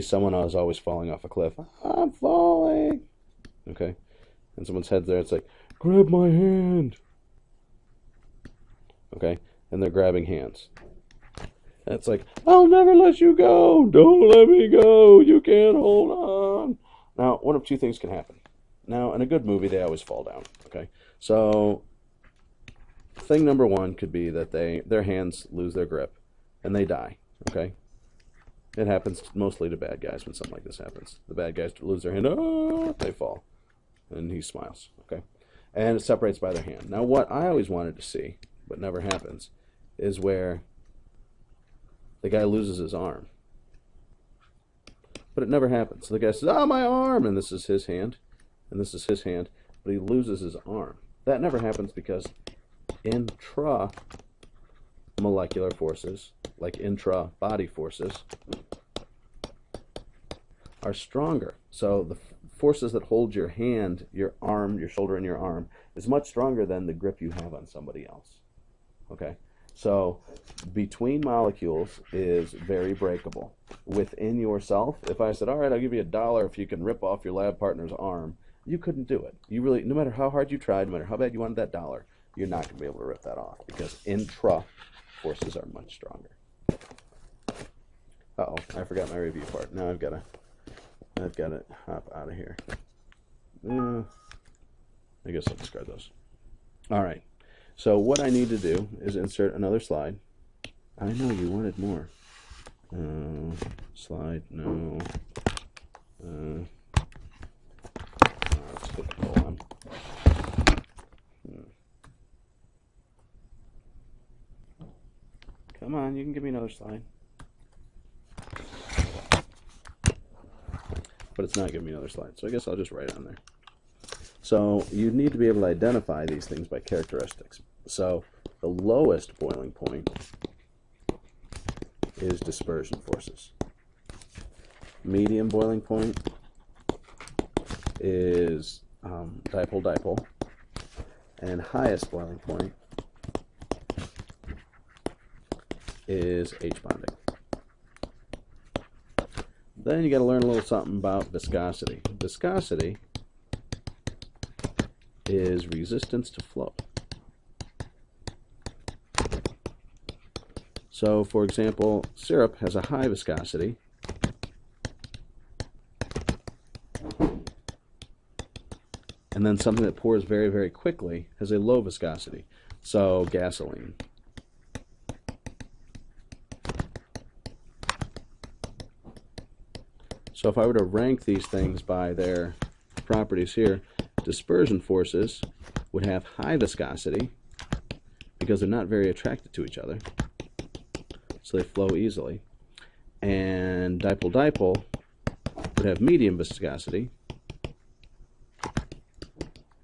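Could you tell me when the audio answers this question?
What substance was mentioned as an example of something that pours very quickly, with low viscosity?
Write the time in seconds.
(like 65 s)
173 s.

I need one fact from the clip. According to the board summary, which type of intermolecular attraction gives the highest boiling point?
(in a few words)
H bonding.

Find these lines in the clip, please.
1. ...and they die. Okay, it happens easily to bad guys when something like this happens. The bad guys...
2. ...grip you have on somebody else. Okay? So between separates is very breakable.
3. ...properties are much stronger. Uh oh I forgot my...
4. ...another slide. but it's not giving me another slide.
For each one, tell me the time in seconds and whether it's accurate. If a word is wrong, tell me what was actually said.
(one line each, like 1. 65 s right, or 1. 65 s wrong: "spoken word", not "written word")
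1. 26 s wrong: "mostly", not "easily"
2. 66 s wrong: "molecules", not "separates"
3. 85 s wrong: "forces", not "properties"
4. 116 s right.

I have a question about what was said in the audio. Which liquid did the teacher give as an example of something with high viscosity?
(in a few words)
Syrup.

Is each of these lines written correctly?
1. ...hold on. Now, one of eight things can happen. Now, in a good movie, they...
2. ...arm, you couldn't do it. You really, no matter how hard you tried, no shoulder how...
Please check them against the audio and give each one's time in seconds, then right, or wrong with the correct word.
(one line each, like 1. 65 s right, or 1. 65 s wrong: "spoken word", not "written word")
1. 15 s wrong: "two", not "eight"
2. 77 s wrong: "matter", not "shoulder".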